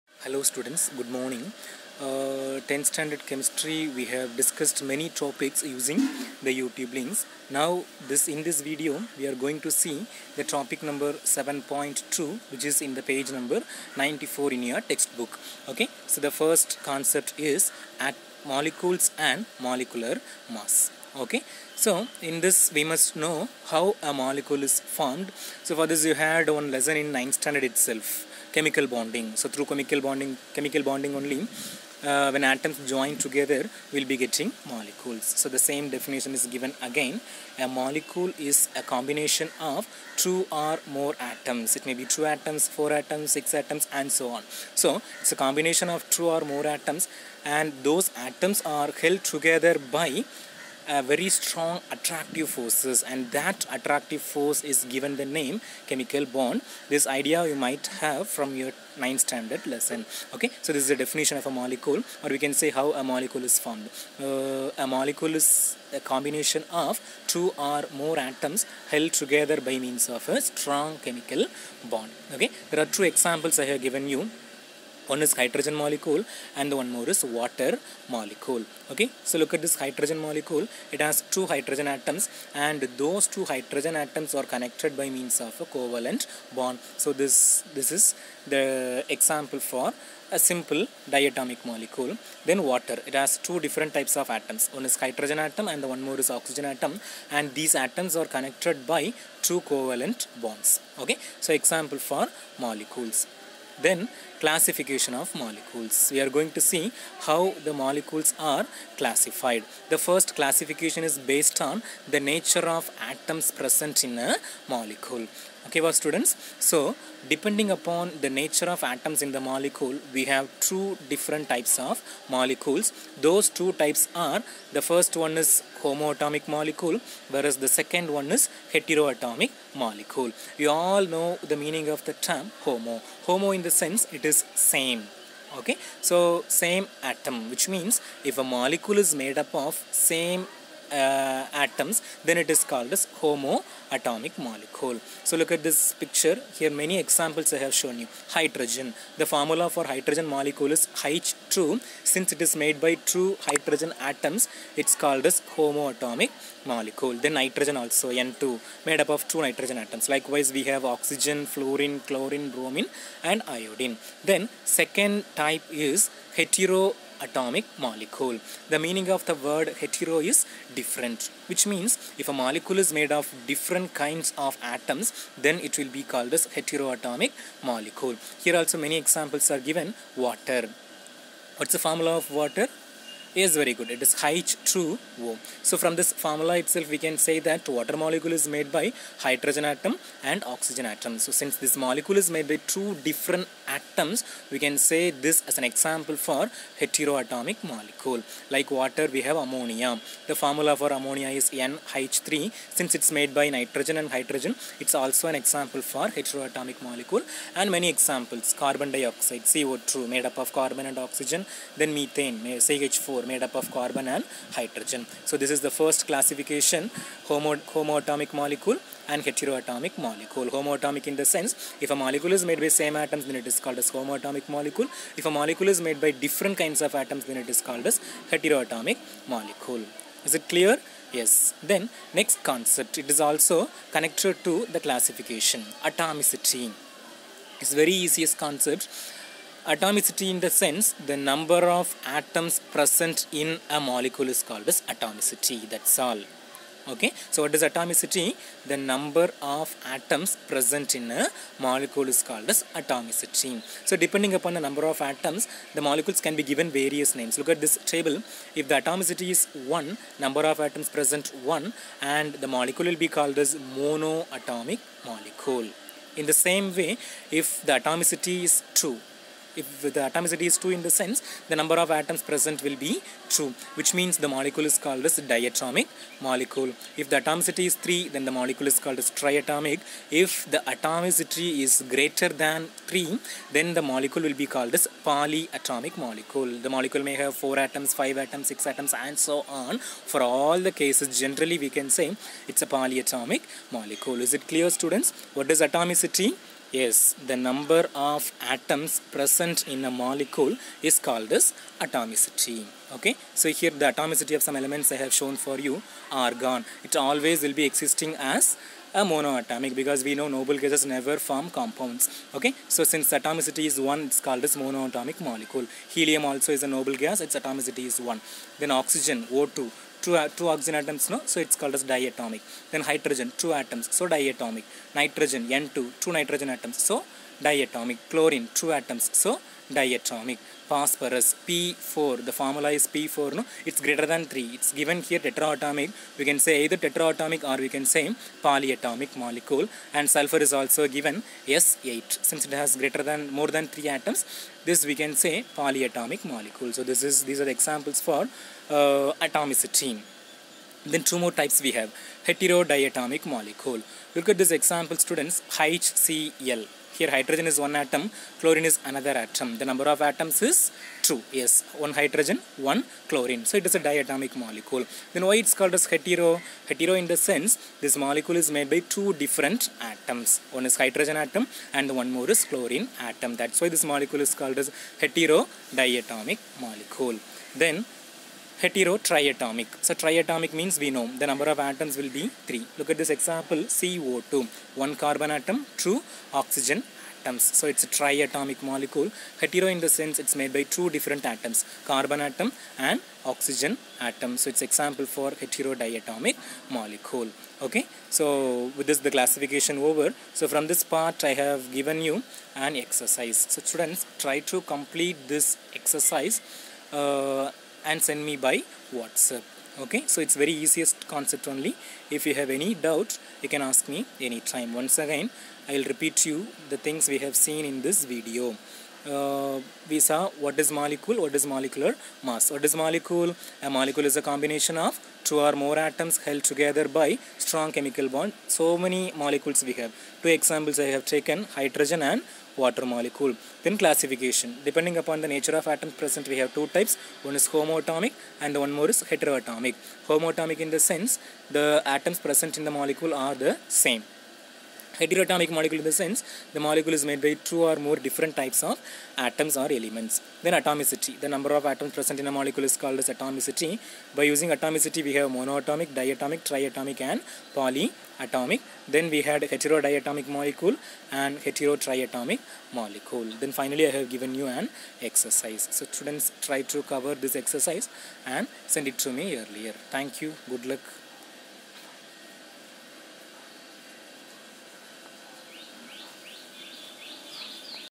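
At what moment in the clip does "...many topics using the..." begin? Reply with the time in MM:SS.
00:04.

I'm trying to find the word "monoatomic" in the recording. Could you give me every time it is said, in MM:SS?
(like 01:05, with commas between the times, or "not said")
04:23, 05:09, 05:14, 07:35.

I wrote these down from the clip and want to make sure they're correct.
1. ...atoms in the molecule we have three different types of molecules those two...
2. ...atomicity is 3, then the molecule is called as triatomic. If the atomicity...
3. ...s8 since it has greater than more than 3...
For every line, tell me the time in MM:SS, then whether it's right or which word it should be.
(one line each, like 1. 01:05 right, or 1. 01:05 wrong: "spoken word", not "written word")
1. 01:58 wrong: "two", not "three"
2. 04:37 right
3. 05:41 right.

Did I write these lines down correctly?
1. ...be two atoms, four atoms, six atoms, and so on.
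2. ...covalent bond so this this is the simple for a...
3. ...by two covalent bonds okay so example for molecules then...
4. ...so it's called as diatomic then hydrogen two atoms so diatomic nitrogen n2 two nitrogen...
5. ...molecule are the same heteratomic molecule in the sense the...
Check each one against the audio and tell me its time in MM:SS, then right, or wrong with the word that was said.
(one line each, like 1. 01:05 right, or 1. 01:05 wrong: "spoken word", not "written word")
1. 00:42 right
2. 01:25 wrong: "example", not "simple"
3. 01:38 right
4. 05:21 right
5. 07:22 right.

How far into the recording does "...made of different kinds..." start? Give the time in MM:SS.
02:52.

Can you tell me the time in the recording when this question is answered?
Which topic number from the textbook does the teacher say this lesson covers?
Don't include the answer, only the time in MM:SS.
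00:11.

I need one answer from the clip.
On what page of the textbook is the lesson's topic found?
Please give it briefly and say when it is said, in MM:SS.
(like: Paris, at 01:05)
94, at 00:13.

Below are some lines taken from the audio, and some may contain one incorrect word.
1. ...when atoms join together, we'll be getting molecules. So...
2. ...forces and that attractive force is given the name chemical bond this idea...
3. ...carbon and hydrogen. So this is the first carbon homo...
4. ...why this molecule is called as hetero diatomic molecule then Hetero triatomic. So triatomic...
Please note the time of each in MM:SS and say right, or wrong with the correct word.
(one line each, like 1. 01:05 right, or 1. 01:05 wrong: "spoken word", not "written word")
1. 00:32 right
2. 00:52 right
3. 03:33 wrong: "classification", not "carbon"
4. 06:13 right.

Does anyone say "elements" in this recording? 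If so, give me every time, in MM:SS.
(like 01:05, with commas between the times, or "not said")
05:04, 07:29.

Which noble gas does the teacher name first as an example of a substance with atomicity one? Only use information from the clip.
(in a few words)
Argon.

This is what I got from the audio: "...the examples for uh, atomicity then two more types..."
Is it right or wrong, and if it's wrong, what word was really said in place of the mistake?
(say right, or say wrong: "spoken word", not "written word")
right.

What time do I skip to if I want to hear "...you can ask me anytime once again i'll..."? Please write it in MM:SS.
06:53.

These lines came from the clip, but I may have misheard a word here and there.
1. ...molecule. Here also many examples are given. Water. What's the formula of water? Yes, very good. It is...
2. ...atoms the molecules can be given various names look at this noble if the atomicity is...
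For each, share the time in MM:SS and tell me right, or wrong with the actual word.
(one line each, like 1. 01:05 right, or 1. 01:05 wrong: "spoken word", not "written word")
1. 02:57 right
2. 04:14 wrong: "table", not "noble".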